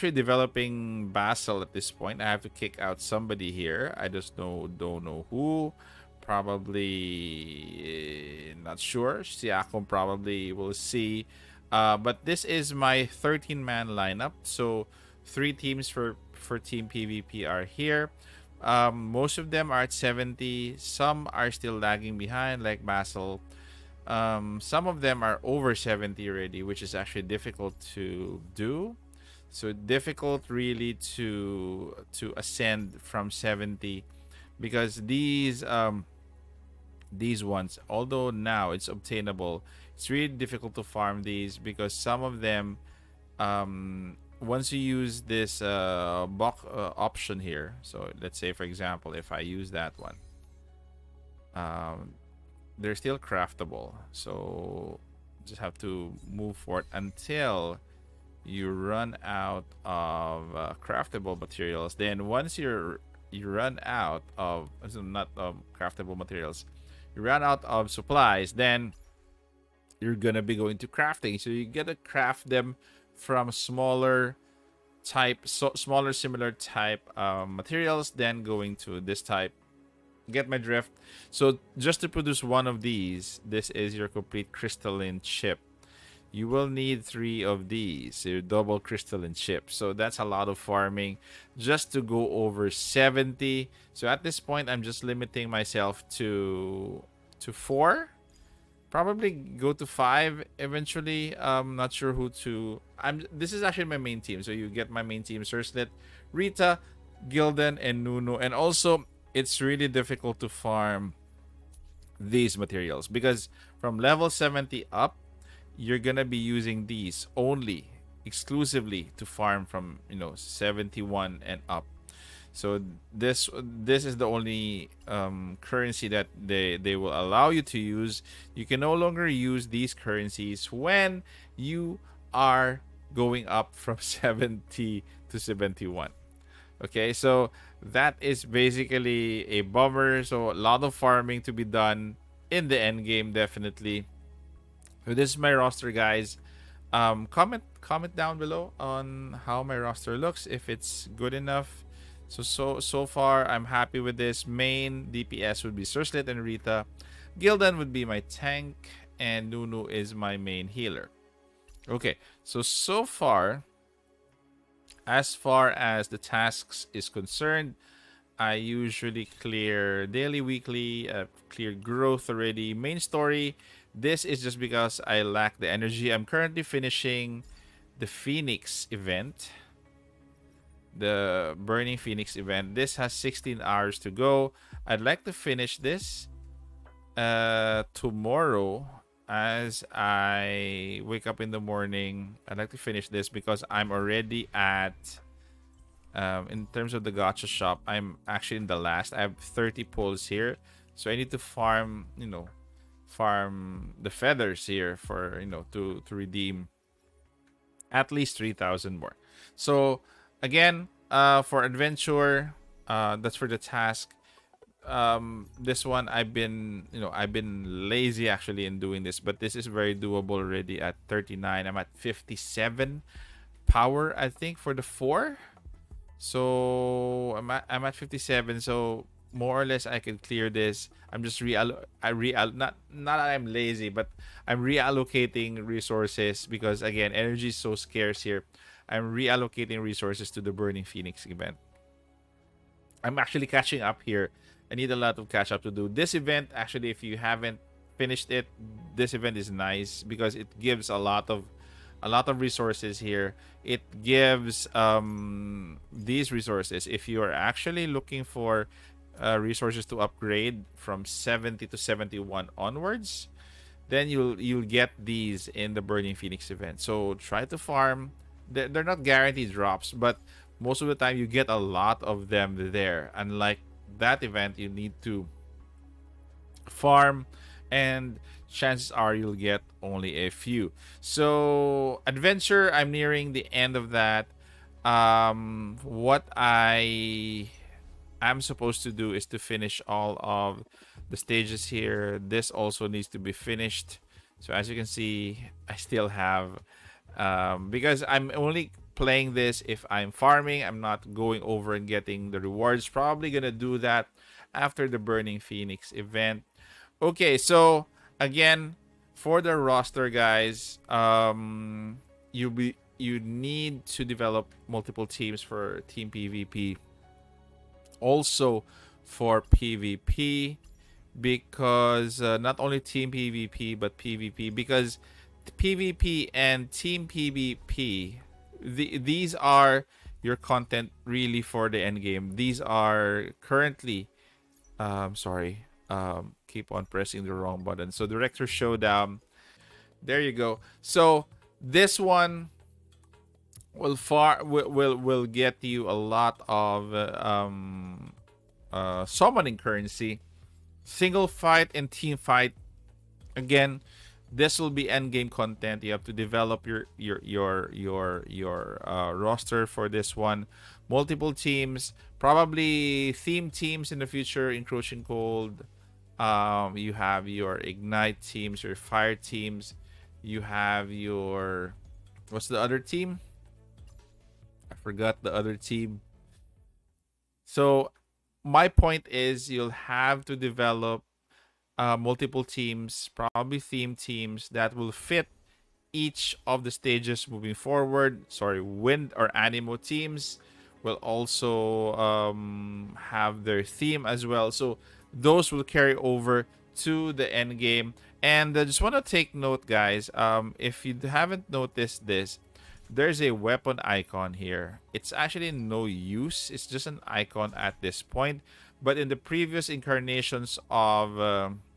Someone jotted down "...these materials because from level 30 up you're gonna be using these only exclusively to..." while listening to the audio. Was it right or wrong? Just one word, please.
wrong.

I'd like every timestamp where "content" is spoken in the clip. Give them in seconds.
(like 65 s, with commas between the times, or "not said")
330 s, 355 s.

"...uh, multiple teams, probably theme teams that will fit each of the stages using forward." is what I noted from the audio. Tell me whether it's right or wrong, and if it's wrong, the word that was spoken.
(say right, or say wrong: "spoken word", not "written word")
wrong: "moving", not "using".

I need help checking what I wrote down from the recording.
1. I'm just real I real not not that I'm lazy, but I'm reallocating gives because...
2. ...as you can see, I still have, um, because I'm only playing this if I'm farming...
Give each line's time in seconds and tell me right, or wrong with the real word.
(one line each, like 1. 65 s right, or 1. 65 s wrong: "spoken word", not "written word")
1. 231 s wrong: "resources", not "gives"
2. 294 s right.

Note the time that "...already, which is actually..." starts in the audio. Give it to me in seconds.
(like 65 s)
26 s.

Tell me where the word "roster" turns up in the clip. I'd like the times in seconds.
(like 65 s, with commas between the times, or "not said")
145 s, 149 s, 309 s, 359 s.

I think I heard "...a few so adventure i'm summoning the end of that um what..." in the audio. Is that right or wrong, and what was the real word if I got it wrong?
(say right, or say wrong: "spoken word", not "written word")
wrong: "nearing", not "summoning".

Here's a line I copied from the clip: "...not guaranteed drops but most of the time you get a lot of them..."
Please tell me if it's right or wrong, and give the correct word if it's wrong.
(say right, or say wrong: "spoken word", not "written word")
right.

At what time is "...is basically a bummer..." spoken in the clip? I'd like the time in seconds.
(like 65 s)
138 s.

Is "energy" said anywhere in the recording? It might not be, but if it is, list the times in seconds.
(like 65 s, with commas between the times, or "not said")
175 s, 237 s.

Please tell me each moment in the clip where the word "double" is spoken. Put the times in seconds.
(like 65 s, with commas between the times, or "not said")
88 s.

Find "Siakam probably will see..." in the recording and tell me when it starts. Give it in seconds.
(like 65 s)
9 s.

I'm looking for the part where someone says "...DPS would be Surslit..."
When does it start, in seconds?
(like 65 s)
155 s.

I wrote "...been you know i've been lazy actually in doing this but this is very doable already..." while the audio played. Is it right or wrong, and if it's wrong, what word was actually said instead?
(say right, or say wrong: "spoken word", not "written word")
right.